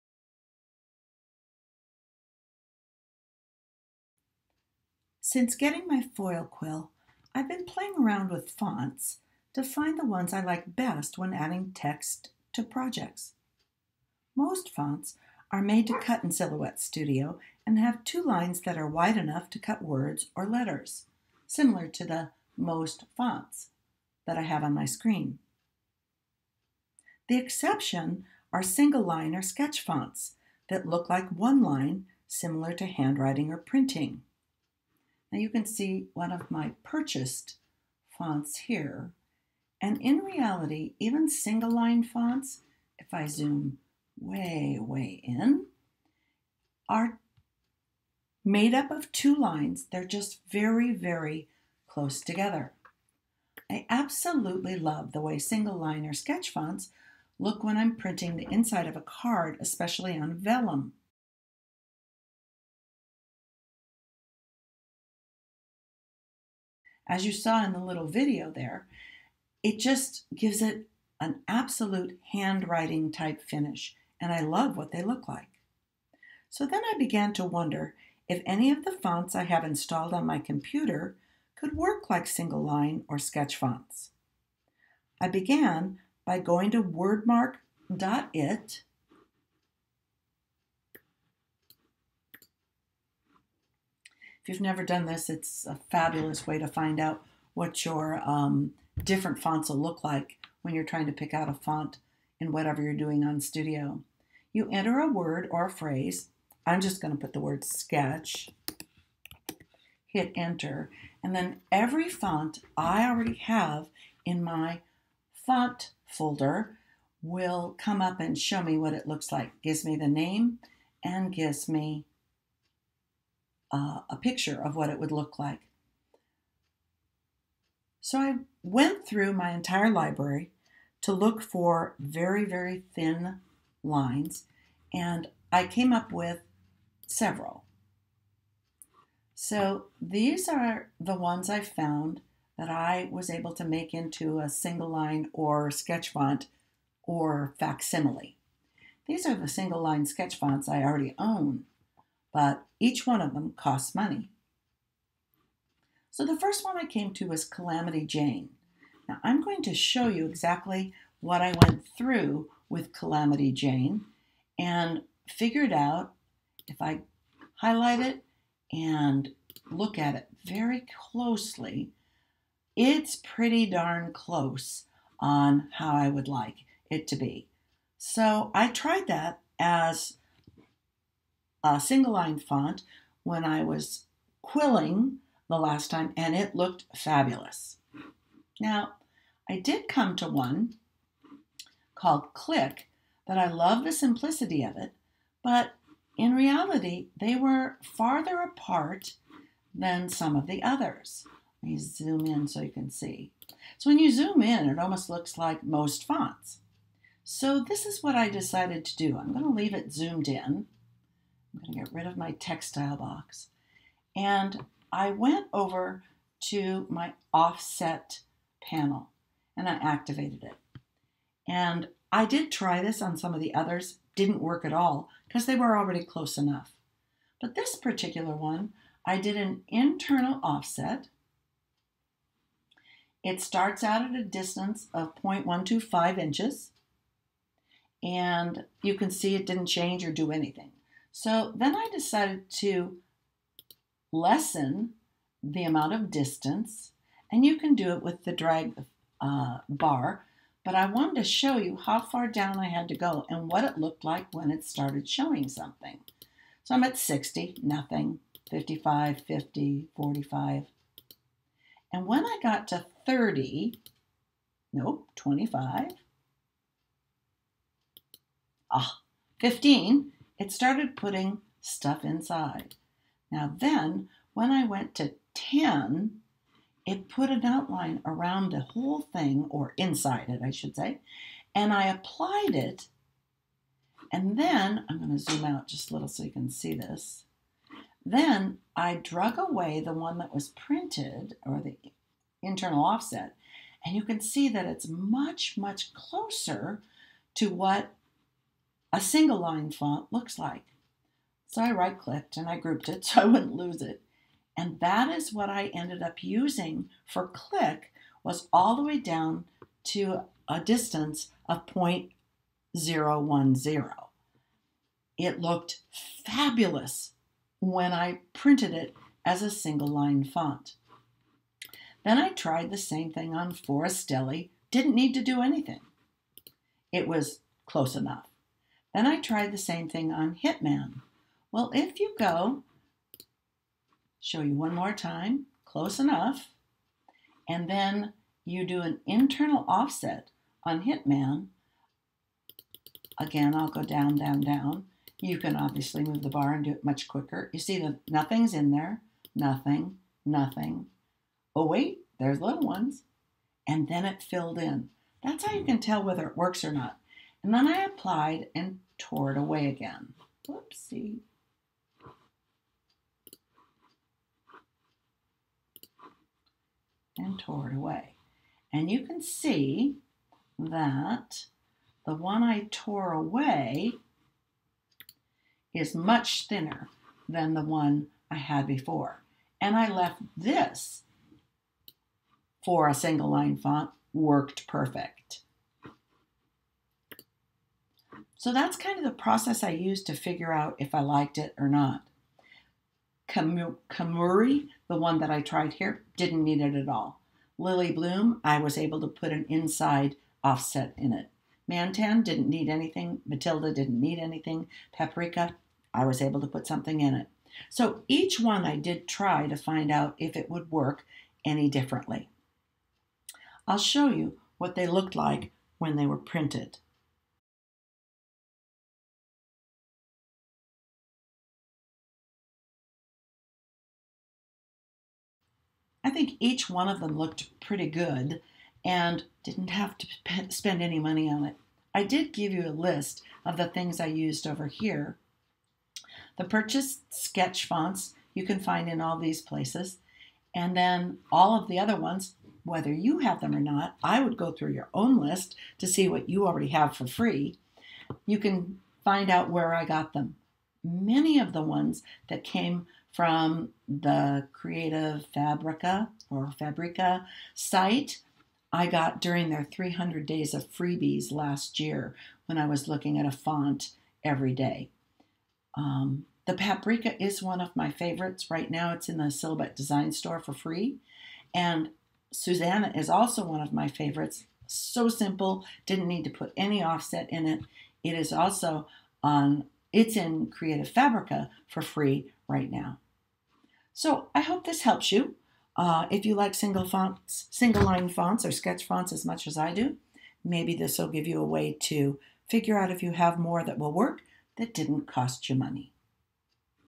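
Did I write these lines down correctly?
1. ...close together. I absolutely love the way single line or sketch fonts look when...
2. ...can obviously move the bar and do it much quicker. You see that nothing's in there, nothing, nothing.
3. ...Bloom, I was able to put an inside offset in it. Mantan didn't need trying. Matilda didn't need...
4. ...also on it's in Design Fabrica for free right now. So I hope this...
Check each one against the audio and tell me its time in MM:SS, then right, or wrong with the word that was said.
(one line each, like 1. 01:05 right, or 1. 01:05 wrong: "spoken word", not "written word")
1. 00:51 right
2. 05:45 right
3. 06:37 wrong: "anything", not "trying"
4. 07:58 wrong: "Creative", not "Design".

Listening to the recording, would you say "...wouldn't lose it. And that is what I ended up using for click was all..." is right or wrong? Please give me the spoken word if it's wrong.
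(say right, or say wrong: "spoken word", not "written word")
right.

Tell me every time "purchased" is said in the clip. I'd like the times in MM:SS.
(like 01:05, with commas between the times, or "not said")
00:36, 07:16.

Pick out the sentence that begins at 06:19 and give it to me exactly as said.
And I left this for a single line font worked perfect.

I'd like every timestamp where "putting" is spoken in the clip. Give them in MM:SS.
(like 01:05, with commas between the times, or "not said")
04:30.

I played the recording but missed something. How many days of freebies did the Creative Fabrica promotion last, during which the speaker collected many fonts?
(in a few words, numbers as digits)
300.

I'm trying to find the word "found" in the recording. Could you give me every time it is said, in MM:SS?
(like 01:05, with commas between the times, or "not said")
02:21.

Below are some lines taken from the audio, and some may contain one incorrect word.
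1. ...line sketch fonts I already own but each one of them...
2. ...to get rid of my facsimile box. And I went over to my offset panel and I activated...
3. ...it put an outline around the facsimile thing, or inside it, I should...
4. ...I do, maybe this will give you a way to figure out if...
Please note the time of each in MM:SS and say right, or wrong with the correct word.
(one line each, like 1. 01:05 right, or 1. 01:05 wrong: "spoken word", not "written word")
1. 02:29 right
2. 03:31 wrong: "textile", not "facsimile"
3. 04:36 wrong: "whole", not "facsimile"
4. 08:09 right.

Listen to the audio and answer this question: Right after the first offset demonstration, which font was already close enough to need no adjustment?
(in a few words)
Forestelli.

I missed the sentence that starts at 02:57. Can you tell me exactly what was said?
So I tried that as a single line font when I was quilling the last time, and it looked fabulous.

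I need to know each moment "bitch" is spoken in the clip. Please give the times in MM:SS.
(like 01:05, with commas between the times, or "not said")
not said.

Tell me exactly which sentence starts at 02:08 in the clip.
So I went through my entire library to look for very, very thin lines, and I came up with several.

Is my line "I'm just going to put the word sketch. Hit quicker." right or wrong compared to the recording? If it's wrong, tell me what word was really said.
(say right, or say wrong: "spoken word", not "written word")
wrong: "enter", not "quicker".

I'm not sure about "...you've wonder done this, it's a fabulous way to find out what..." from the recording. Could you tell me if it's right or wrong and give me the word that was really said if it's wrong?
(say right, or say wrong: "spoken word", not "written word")
wrong: "never", not "wonder".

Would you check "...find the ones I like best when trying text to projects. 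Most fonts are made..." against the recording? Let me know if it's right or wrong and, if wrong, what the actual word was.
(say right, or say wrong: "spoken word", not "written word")
wrong: "adding", not "trying".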